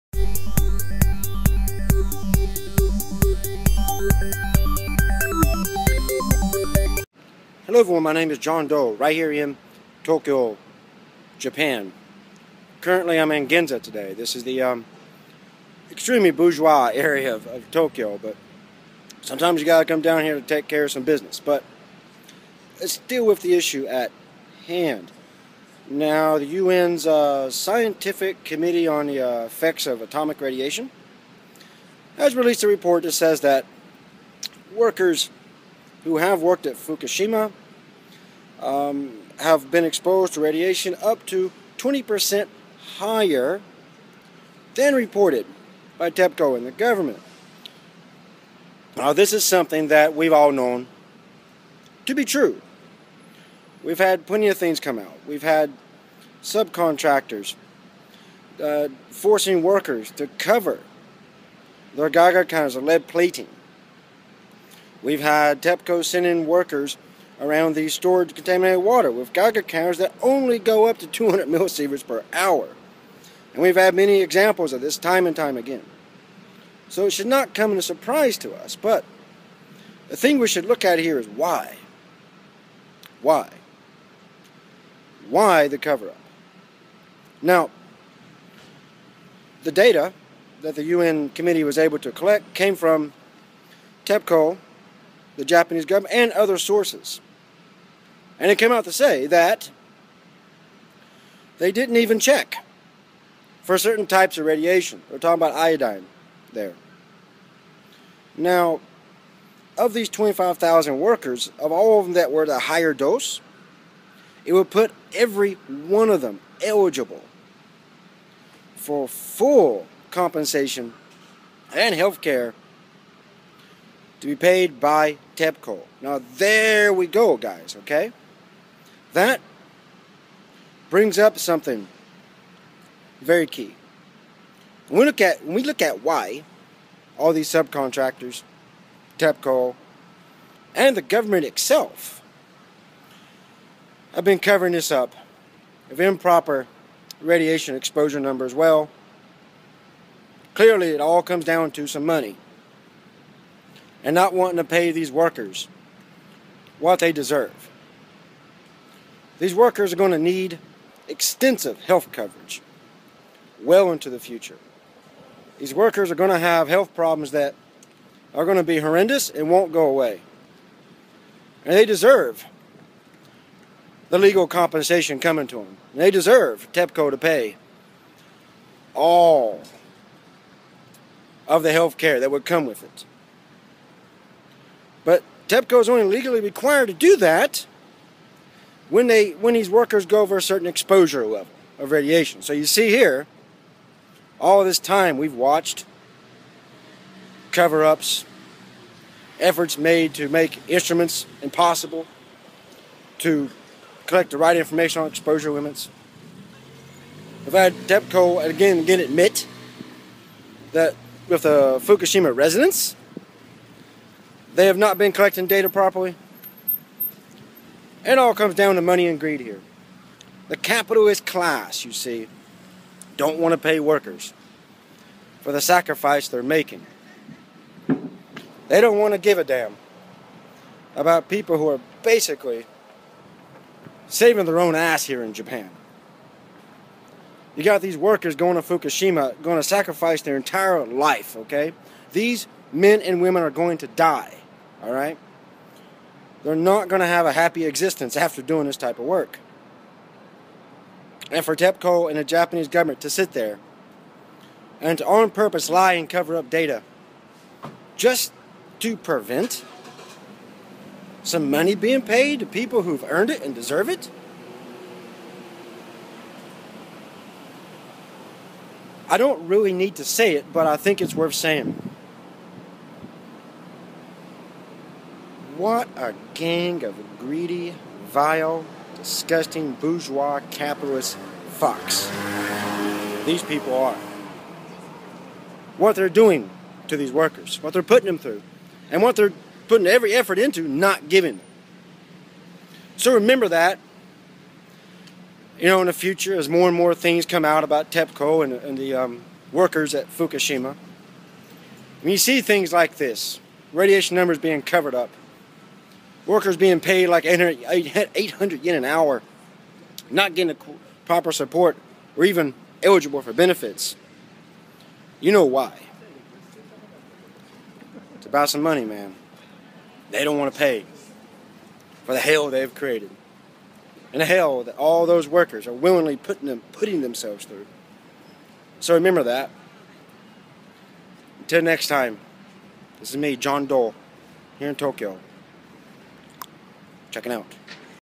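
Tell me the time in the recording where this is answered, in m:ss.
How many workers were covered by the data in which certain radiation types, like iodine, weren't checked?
1:50.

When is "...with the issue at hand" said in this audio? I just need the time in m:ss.
0:23.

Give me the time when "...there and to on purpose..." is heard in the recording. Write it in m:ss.
4:13.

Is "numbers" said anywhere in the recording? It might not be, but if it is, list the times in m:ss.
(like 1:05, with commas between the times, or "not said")
2:28, 5:04.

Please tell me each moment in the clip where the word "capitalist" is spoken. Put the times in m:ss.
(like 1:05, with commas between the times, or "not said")
3:40, 4:40.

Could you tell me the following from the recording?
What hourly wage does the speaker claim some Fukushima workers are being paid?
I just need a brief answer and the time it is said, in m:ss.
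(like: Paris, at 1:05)
800 yen, at 5:07.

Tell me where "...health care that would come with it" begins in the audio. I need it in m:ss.
3:01.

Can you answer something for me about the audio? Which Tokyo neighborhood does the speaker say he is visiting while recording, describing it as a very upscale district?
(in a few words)
Ginza.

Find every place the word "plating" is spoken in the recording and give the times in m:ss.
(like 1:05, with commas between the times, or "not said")
1:03.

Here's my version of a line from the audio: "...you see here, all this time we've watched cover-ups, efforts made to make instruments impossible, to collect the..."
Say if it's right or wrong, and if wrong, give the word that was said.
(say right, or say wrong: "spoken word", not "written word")
right.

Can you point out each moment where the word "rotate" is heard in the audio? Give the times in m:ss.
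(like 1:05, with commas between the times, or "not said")
not said.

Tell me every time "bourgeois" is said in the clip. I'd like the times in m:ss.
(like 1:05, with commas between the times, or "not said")
0:16, 4:39.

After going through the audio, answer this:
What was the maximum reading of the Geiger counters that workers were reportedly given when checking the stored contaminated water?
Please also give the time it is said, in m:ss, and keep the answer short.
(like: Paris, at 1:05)
200 millisieverts per hour, at 1:11.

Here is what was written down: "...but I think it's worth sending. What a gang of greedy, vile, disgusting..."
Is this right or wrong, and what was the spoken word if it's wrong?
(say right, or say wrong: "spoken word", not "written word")
wrong: "saying", not "sending".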